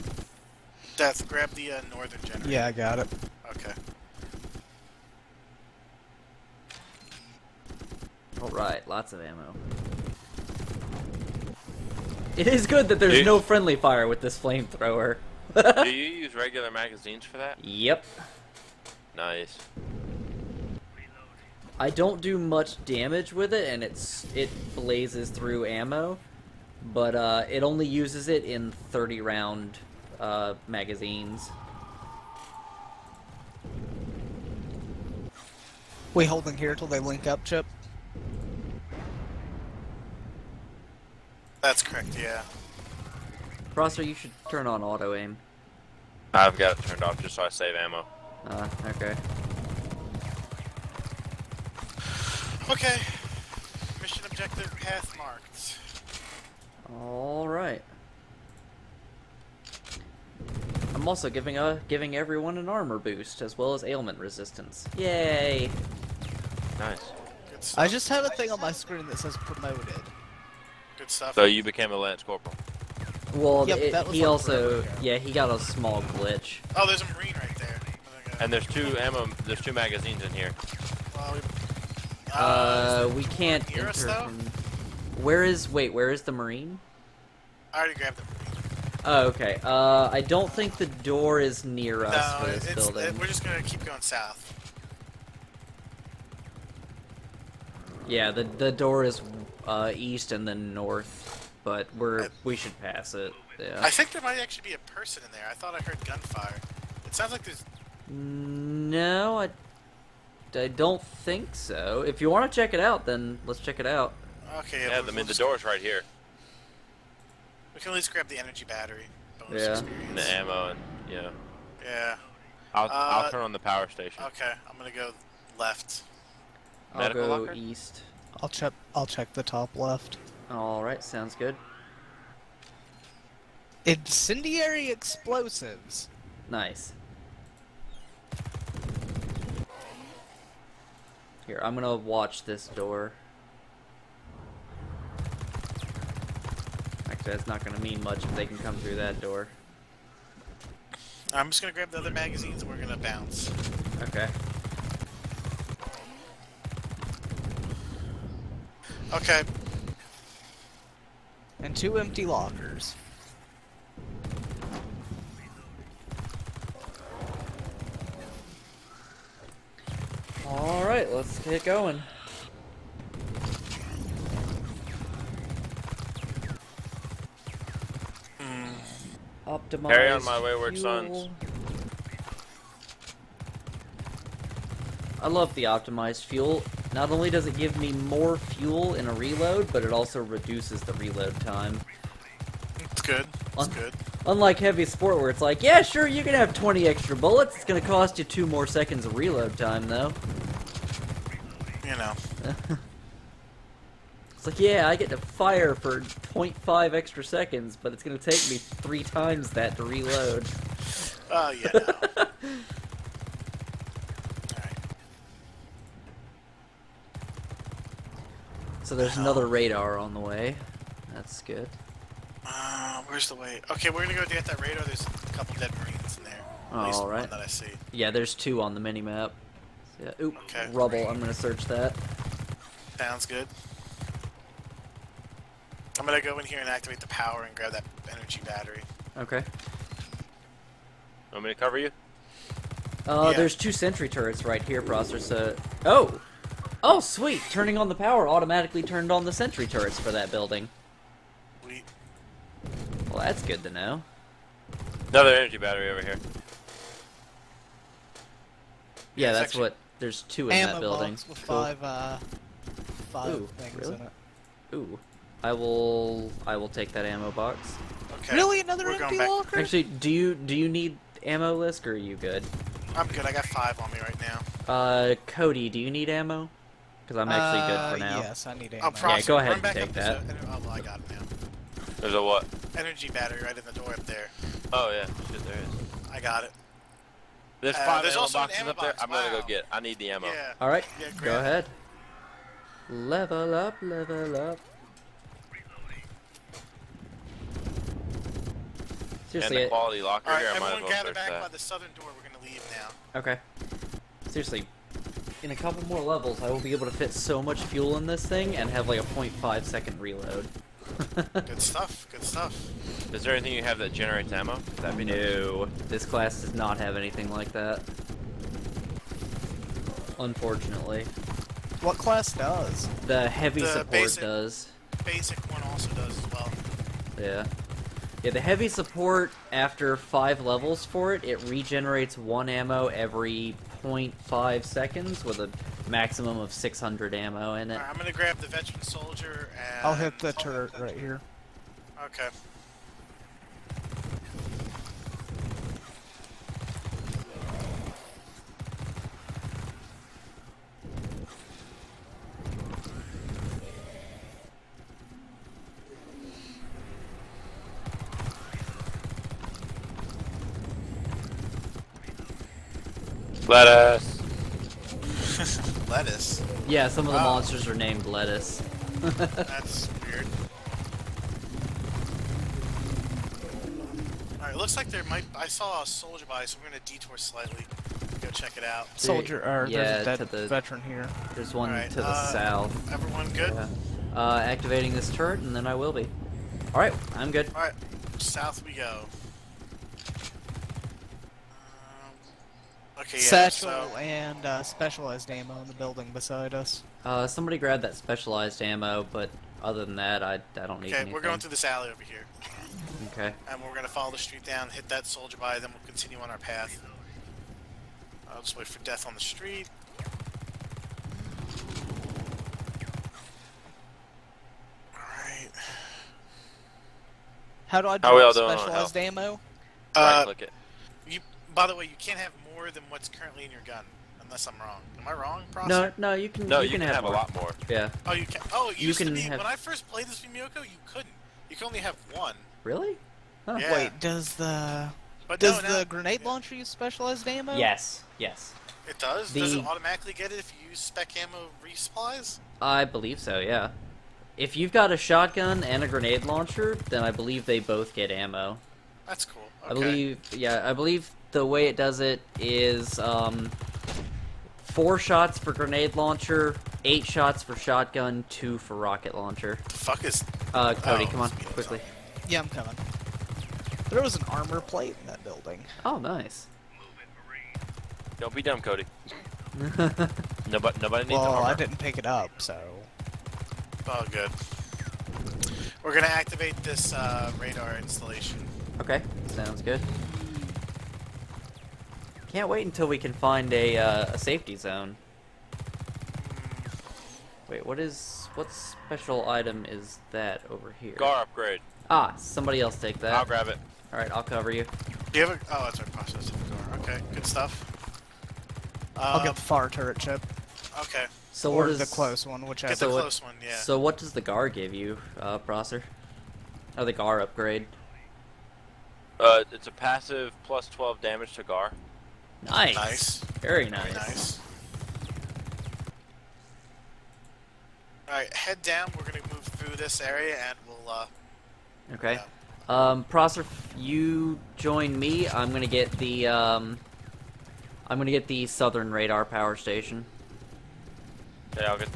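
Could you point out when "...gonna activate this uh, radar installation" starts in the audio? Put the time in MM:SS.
07:55.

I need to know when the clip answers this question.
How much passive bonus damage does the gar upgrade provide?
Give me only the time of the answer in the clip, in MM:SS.
08:30.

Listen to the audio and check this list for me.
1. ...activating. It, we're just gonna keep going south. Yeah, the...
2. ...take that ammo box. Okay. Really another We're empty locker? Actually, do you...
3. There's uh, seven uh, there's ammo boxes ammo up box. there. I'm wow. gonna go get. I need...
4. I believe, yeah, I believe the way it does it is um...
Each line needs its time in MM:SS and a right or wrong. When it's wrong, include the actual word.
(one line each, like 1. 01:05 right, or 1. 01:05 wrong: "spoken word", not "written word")
1. 01:32 wrong: "building", not "activating"
2. 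04:26 right
3. 04:47 wrong: "five", not "seven"
4. 07:29 right.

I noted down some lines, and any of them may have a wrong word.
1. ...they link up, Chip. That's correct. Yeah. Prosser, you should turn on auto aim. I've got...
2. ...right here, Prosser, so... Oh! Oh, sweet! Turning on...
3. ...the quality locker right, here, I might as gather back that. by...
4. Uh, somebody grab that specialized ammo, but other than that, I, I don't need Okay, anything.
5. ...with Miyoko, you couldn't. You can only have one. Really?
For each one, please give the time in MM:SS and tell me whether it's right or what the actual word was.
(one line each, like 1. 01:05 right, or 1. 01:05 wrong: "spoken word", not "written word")
1. 00:36 right
2. 04:04 right
3. 04:59 right
4. 06:37 right
5. 07:10 right.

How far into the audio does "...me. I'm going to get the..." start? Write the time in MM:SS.
08:44.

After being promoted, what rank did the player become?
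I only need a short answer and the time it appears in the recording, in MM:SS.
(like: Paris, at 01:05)
lance corporal, at 01:11.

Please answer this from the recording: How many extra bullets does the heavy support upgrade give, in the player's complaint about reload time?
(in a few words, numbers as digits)
20.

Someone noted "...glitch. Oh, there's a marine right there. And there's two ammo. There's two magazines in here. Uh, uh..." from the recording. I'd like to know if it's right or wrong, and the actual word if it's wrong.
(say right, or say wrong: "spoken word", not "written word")
right.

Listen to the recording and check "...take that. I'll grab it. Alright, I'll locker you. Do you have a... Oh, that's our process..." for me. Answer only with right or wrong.
wrong.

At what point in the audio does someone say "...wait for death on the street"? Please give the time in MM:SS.
06:48.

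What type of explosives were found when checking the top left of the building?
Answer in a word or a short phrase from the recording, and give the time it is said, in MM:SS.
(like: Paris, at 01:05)
Incendiary explosives, at 02:13.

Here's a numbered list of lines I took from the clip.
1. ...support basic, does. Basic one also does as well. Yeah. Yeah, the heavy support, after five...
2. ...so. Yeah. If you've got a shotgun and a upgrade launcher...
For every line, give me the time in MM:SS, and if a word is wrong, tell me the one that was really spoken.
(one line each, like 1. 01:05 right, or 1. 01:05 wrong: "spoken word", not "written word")
1. 05:23 right
2. 07:23 wrong: "grenade", not "upgrade".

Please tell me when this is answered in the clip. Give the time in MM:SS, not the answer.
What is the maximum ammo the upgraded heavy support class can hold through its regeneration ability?
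05:36.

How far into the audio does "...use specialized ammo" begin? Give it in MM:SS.
07:16.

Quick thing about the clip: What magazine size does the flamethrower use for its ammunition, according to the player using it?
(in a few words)
30 rounds.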